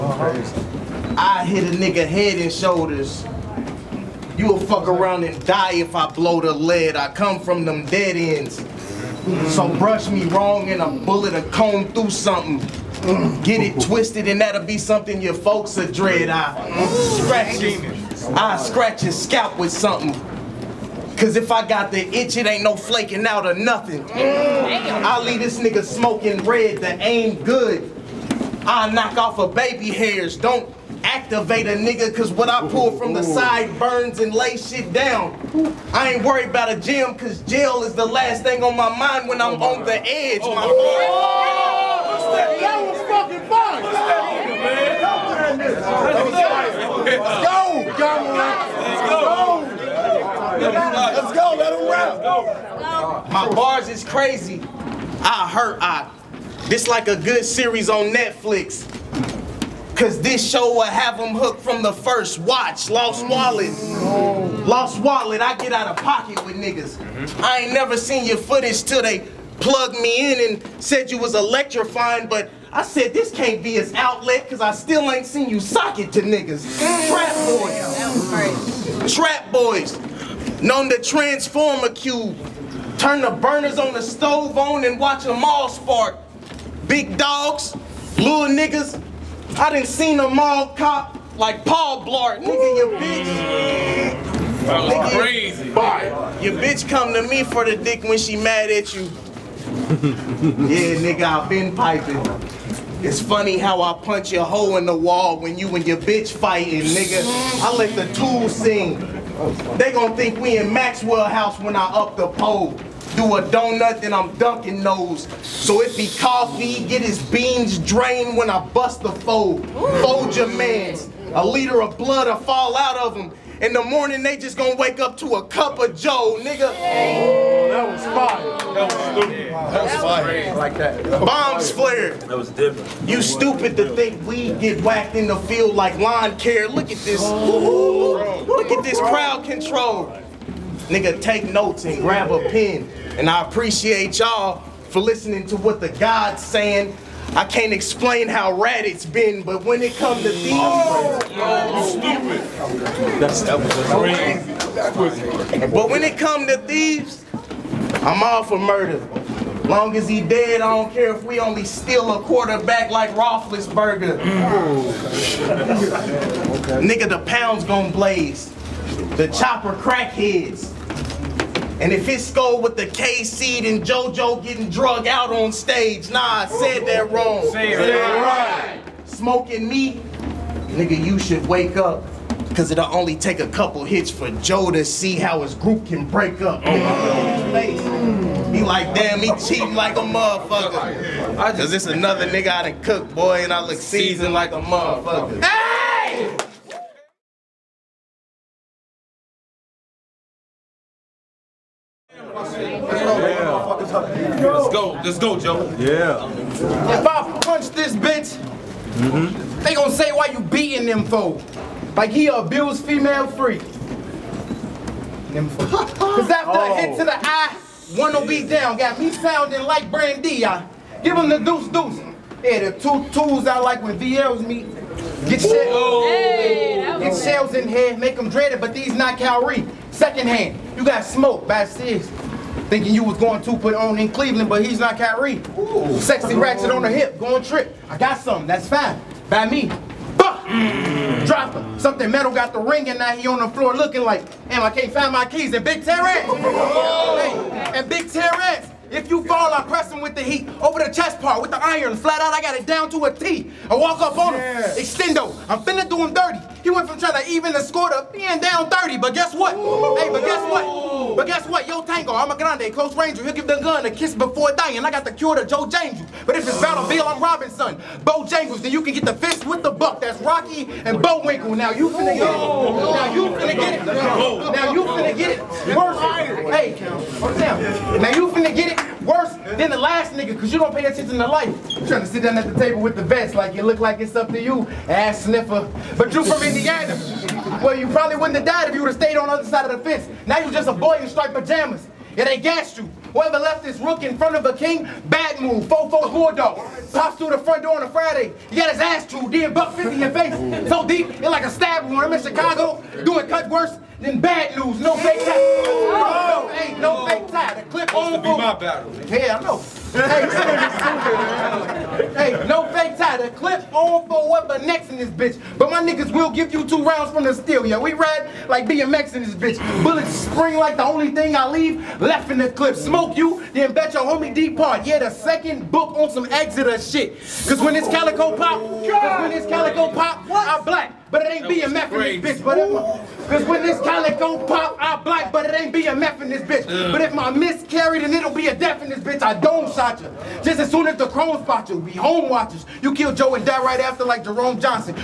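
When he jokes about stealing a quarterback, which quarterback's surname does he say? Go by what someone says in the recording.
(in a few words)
Roethlisberger.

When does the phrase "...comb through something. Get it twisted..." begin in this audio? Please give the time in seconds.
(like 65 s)
11 s.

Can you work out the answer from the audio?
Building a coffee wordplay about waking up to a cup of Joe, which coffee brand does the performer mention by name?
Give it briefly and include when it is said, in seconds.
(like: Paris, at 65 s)
Maxwell House, at 110 s.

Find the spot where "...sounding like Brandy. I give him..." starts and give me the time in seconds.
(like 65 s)
219 s.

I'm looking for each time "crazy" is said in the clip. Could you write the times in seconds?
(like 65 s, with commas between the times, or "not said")
54 s, 95 s, 155 s.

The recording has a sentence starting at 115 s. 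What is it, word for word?
So it be coffee, get his beans drained when I bust the fold.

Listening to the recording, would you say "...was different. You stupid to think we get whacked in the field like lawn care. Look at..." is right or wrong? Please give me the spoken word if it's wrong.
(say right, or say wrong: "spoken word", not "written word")
right.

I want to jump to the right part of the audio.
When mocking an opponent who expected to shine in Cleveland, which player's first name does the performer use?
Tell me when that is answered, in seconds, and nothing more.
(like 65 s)
234 s.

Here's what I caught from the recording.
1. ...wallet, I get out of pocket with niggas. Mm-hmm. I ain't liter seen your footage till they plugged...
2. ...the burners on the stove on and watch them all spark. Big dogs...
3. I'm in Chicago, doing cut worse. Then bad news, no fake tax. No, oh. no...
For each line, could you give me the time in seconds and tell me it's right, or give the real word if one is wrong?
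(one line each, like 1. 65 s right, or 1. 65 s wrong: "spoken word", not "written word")
1. 64 s wrong: "never", not "liter"
2. 83 s right
3. 302 s right.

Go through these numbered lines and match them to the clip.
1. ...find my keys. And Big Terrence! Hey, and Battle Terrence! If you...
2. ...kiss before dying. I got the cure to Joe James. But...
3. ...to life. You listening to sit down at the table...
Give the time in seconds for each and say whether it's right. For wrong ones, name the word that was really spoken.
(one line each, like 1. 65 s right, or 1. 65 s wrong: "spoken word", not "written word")
1. 244 s wrong: "Big", not "Battle"
2. 263 s right
3. 281 s wrong: "trying", not "listening".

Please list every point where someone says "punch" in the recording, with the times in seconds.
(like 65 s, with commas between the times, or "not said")
104 s, 207 s.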